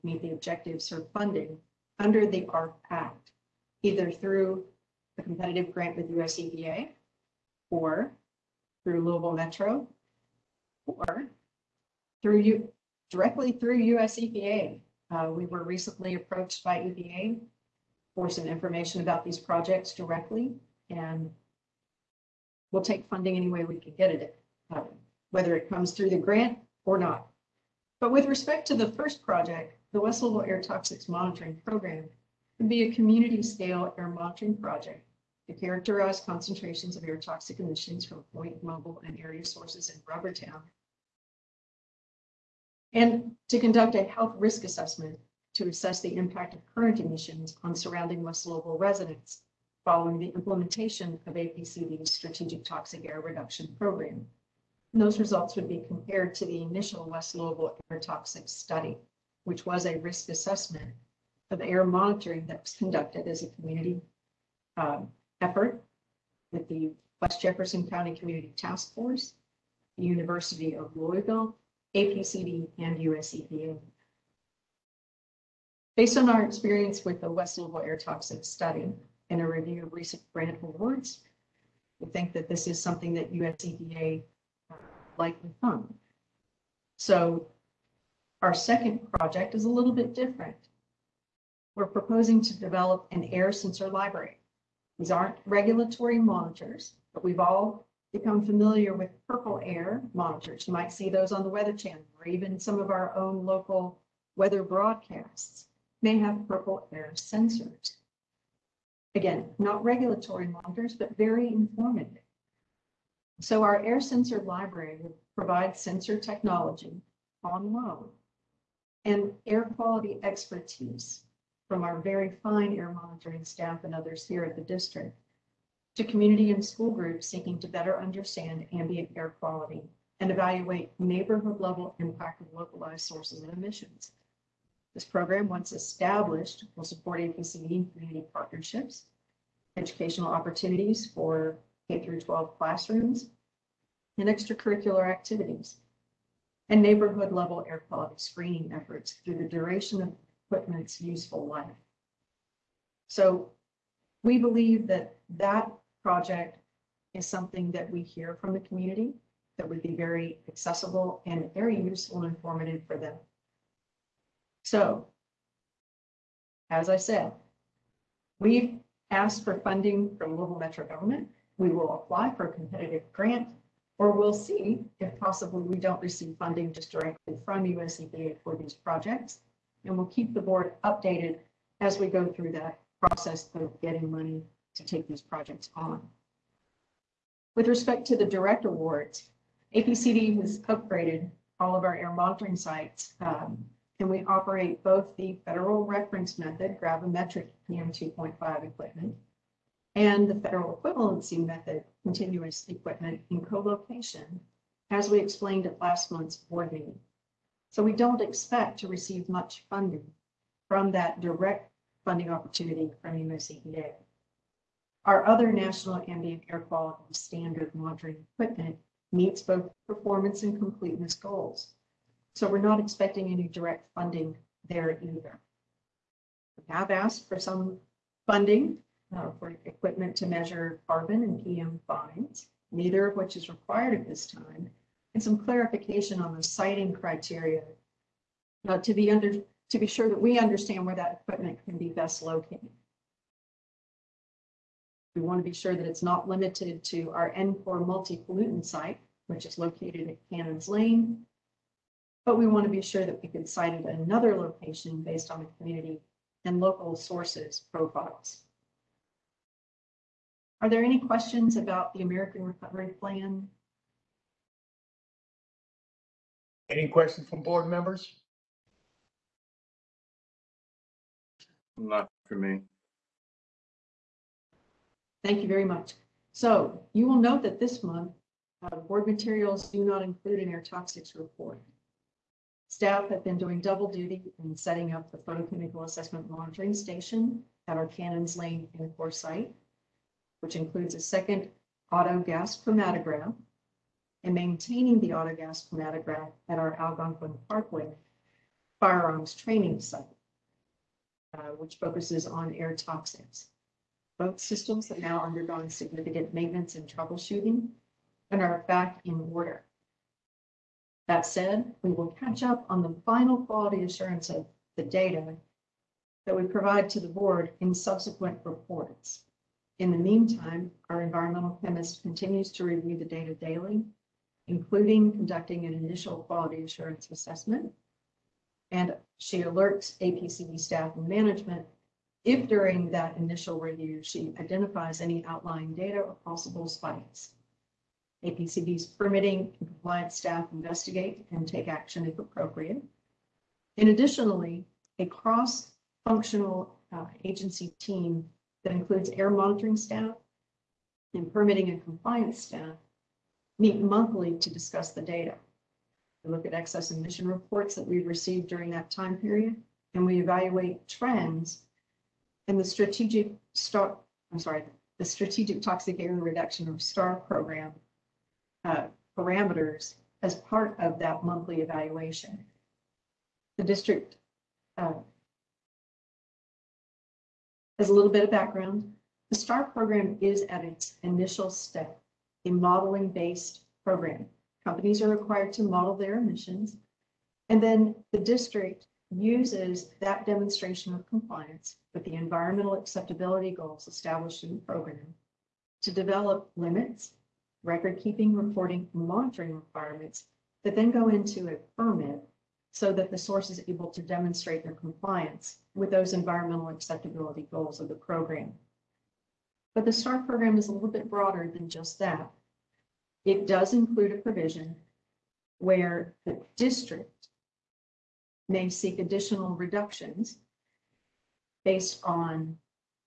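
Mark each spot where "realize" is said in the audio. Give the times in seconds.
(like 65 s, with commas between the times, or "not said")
not said.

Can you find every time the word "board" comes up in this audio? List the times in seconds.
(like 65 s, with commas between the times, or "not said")
180 s, 206 s, 267 s, 278 s, 317 s.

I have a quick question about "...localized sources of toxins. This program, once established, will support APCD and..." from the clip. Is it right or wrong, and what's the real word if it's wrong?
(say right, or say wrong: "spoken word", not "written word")
wrong: "emissions", not "toxins".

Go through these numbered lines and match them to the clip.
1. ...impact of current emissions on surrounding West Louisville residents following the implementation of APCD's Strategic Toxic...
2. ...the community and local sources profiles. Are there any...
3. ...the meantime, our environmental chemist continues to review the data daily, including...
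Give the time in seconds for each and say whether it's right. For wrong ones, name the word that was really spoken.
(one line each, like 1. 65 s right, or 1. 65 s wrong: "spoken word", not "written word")
1. 46 s right
2. 255 s right
3. 319 s right.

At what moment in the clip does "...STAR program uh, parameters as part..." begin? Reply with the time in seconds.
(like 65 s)
366 s.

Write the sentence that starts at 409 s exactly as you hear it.
But the START program is a little bit broader than just that.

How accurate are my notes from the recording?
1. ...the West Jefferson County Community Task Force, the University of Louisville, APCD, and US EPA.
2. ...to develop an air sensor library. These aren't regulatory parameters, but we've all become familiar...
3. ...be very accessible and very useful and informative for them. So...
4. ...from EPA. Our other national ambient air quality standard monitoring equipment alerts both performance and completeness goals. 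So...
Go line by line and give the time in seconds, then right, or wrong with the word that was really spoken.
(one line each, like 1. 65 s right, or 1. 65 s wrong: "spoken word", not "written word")
1. 66 s right
2. 92 s wrong: "monitors", not "parameters"
3. 159 s right
4. 213 s wrong: "meets", not "alerts".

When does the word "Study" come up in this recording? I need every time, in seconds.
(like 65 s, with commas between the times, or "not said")
58 s, 78 s.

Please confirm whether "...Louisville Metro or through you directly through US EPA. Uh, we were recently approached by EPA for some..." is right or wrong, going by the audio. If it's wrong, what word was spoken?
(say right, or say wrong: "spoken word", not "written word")
right.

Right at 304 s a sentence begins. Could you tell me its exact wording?
Both systems have now undergone significant maintenance and troubleshooting and are back in order.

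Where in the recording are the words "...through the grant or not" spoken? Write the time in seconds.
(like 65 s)
25 s.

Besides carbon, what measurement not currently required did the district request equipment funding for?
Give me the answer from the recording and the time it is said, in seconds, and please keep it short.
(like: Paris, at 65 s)
PM fines, at 231 s.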